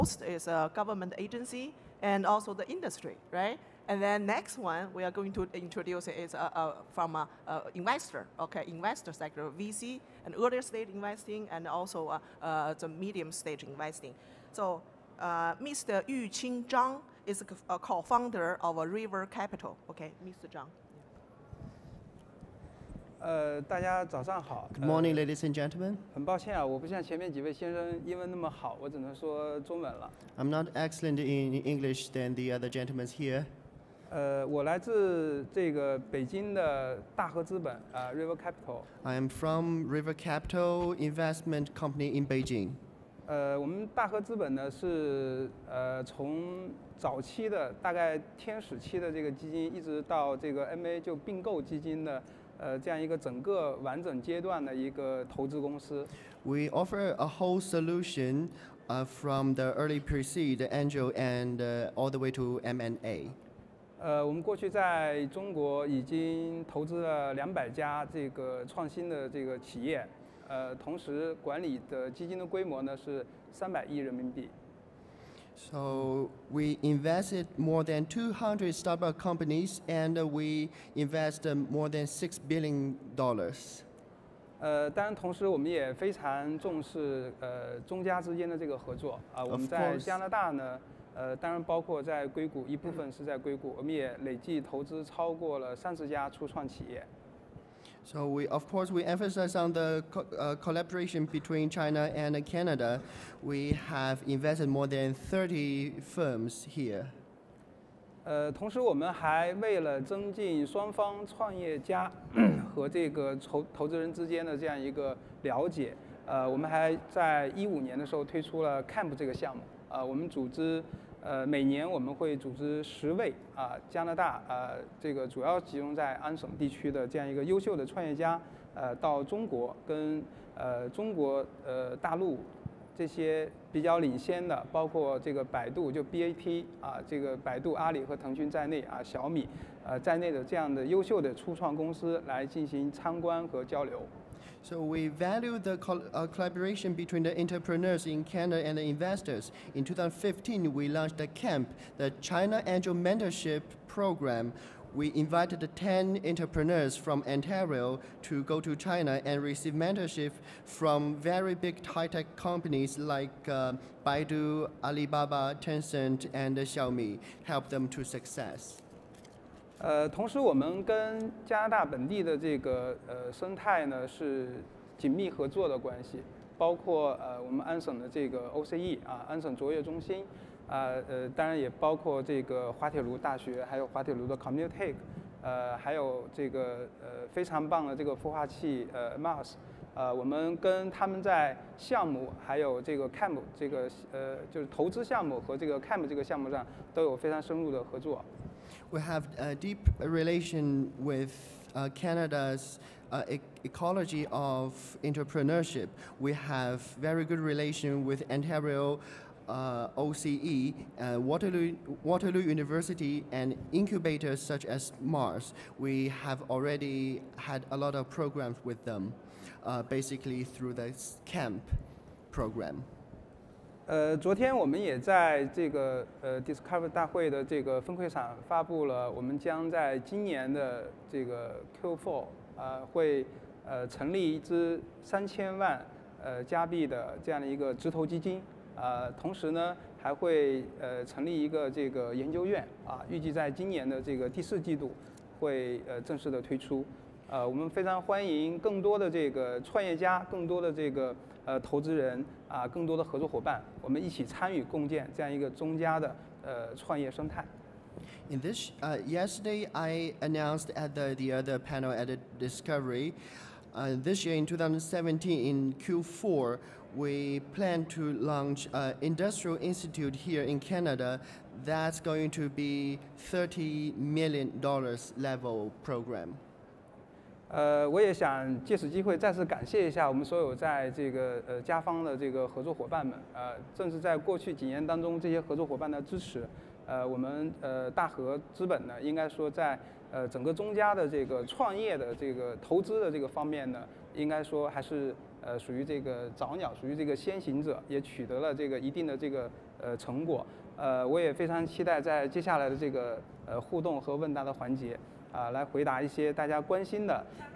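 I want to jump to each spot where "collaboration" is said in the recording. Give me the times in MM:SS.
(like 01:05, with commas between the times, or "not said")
01:40, 02:26.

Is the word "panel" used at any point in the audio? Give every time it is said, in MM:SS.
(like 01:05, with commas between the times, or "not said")
04:21.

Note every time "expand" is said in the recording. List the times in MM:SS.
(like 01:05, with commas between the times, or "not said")
not said.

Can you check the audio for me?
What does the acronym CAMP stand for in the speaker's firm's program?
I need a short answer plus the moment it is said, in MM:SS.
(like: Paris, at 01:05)
China Angel Mentorship Program, at 02:32.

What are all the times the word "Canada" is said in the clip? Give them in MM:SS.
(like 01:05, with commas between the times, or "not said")
01:42, 02:28, 03:21, 04:30.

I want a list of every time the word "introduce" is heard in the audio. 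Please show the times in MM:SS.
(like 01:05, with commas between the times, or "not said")
00:05.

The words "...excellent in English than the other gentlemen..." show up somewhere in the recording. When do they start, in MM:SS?
00:30.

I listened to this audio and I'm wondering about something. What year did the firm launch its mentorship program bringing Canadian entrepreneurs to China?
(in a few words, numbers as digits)
2015.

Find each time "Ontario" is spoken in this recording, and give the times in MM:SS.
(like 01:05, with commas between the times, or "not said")
02:37, 03:28.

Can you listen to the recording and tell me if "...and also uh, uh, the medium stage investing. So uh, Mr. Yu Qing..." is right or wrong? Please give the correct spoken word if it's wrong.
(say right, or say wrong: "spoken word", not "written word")
right.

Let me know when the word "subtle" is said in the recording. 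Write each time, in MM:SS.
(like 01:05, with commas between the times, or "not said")
not said.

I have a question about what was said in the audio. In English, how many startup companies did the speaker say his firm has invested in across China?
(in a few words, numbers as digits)
more than 200.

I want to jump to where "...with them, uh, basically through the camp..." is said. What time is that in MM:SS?
03:38.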